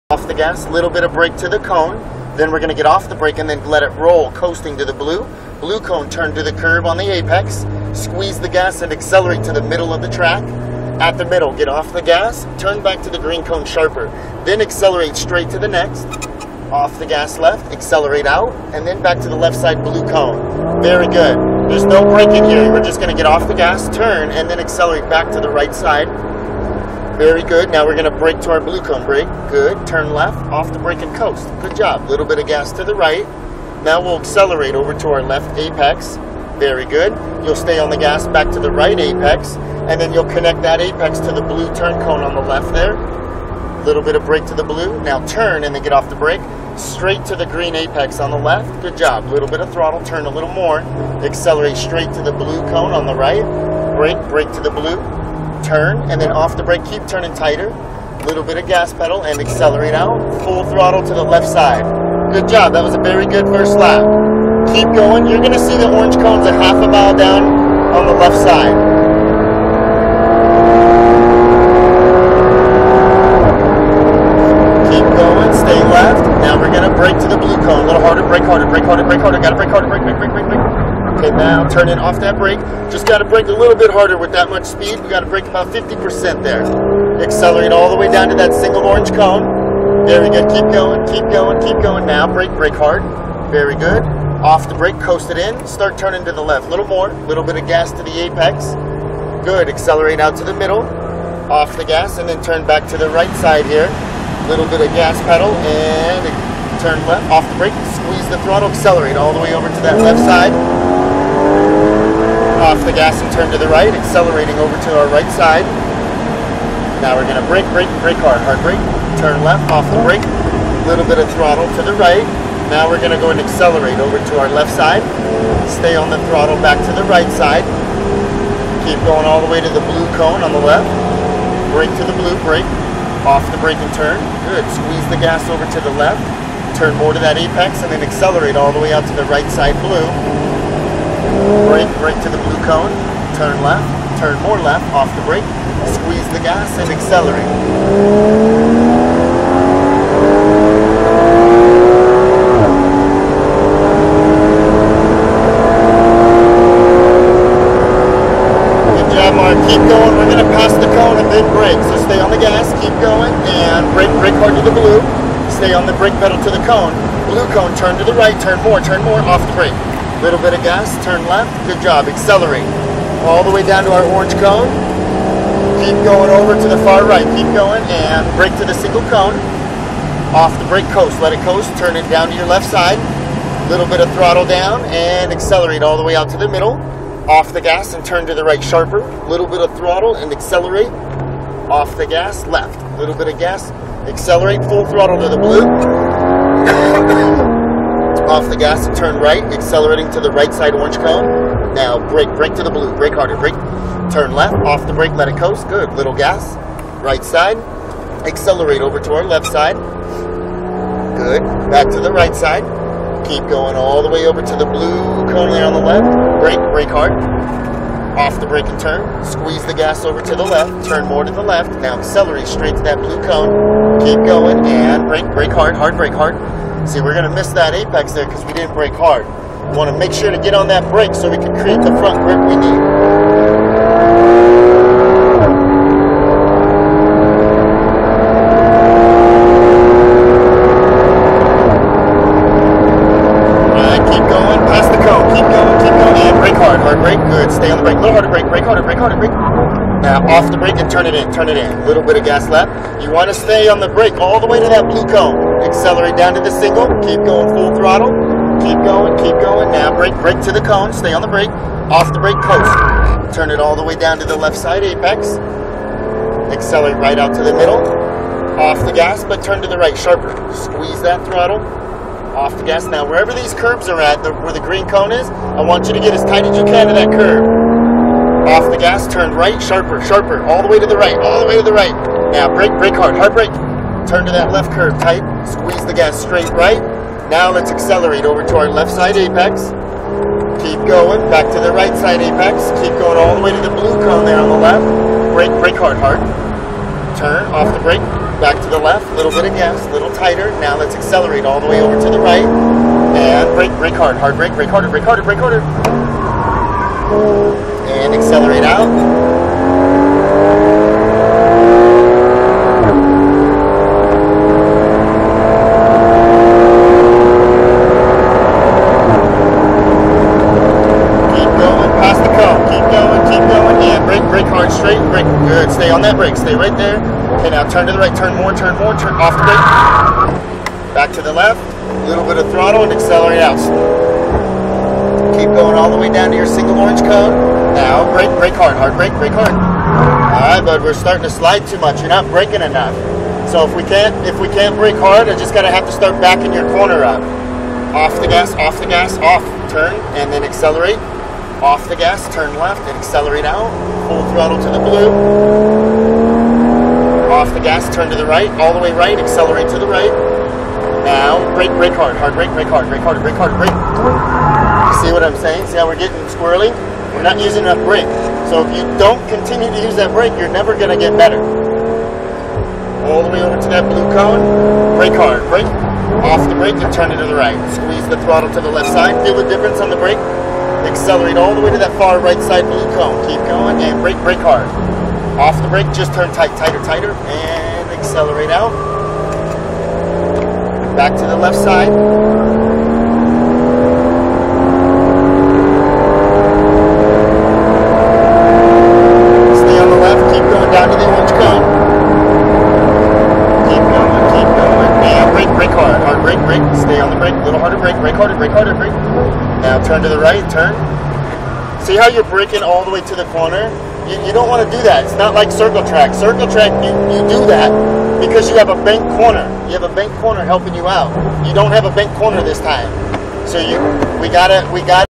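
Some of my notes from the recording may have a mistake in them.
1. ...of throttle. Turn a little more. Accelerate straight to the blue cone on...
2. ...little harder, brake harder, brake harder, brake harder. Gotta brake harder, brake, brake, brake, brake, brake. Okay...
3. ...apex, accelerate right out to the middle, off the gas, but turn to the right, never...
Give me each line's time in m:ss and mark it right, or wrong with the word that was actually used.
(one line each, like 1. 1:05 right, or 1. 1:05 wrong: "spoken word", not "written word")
1. 0:49 right
2. 1:17 right
3. 4:24 wrong: "sharper", not "never".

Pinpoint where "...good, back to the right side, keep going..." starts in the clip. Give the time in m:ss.
3:31.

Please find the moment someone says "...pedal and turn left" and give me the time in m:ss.
1:45.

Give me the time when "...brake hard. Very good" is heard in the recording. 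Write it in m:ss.
1:32.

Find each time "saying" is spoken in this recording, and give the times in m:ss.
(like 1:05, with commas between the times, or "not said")
6:05.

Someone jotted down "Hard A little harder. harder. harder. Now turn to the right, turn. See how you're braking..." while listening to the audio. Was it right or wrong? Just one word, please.
right.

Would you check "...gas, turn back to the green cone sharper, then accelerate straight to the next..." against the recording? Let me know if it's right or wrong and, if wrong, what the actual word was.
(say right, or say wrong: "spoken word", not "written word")
right.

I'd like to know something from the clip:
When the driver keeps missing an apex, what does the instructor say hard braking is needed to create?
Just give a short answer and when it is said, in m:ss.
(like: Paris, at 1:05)
front grip, at 3:52.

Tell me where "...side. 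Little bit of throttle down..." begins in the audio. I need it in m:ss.
3:02.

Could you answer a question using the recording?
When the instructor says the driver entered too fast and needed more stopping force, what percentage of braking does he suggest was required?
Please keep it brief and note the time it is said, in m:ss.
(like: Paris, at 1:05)
50%, at 1:25.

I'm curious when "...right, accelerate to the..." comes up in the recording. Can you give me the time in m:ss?
5:58.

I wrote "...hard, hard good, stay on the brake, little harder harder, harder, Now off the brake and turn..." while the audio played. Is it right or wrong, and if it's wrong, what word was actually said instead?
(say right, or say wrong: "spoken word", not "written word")
right.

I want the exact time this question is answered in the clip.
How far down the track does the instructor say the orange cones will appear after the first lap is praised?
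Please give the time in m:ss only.
1:06.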